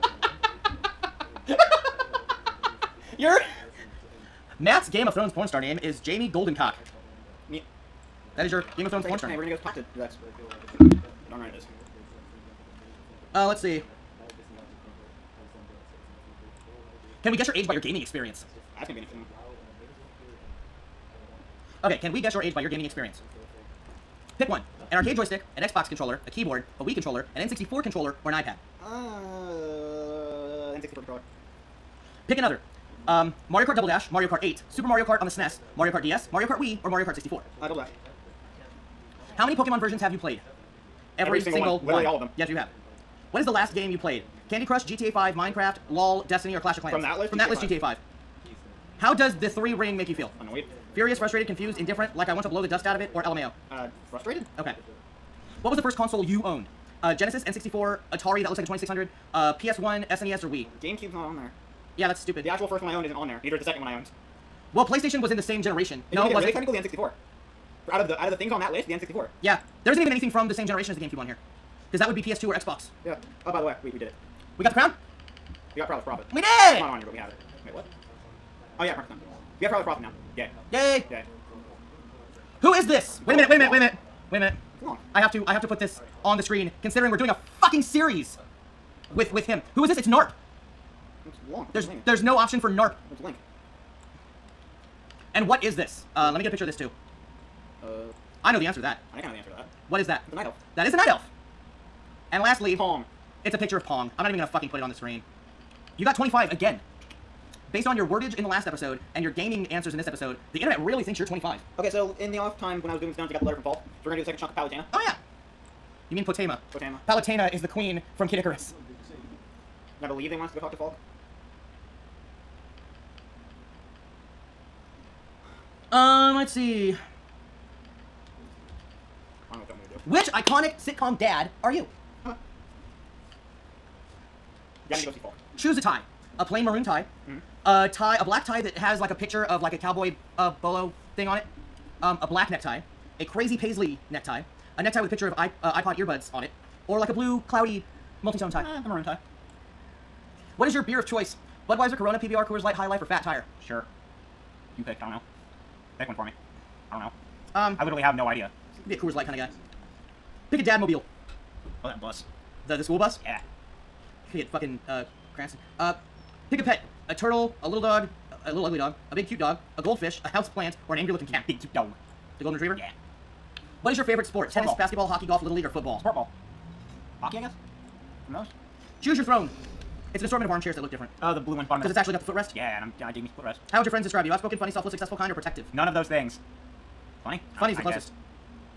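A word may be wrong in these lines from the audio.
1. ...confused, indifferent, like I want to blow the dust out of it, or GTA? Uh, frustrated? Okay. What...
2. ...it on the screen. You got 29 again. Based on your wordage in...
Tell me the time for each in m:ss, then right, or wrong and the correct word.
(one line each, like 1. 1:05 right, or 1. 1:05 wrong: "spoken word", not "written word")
1. 0:51 wrong: "LMAO", not "GTA"
2. 1:44 wrong: "25", not "29".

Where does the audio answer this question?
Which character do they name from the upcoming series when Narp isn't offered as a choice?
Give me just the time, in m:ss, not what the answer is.
1:33.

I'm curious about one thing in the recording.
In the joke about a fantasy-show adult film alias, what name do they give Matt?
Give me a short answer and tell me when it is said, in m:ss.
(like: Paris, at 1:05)
Jamie Goldencock, at 0:06.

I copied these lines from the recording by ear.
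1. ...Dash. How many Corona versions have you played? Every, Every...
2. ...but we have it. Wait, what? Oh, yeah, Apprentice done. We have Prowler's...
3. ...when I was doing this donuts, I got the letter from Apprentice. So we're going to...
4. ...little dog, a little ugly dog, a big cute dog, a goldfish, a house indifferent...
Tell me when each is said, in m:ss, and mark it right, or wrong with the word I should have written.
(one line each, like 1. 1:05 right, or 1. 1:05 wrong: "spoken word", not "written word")
1. 0:37 wrong: "Pokemon", not "Corona"
2. 1:17 right
3. 1:52 wrong: "Falk", not "Apprentice"
4. 2:47 wrong: "plant", not "indifferent".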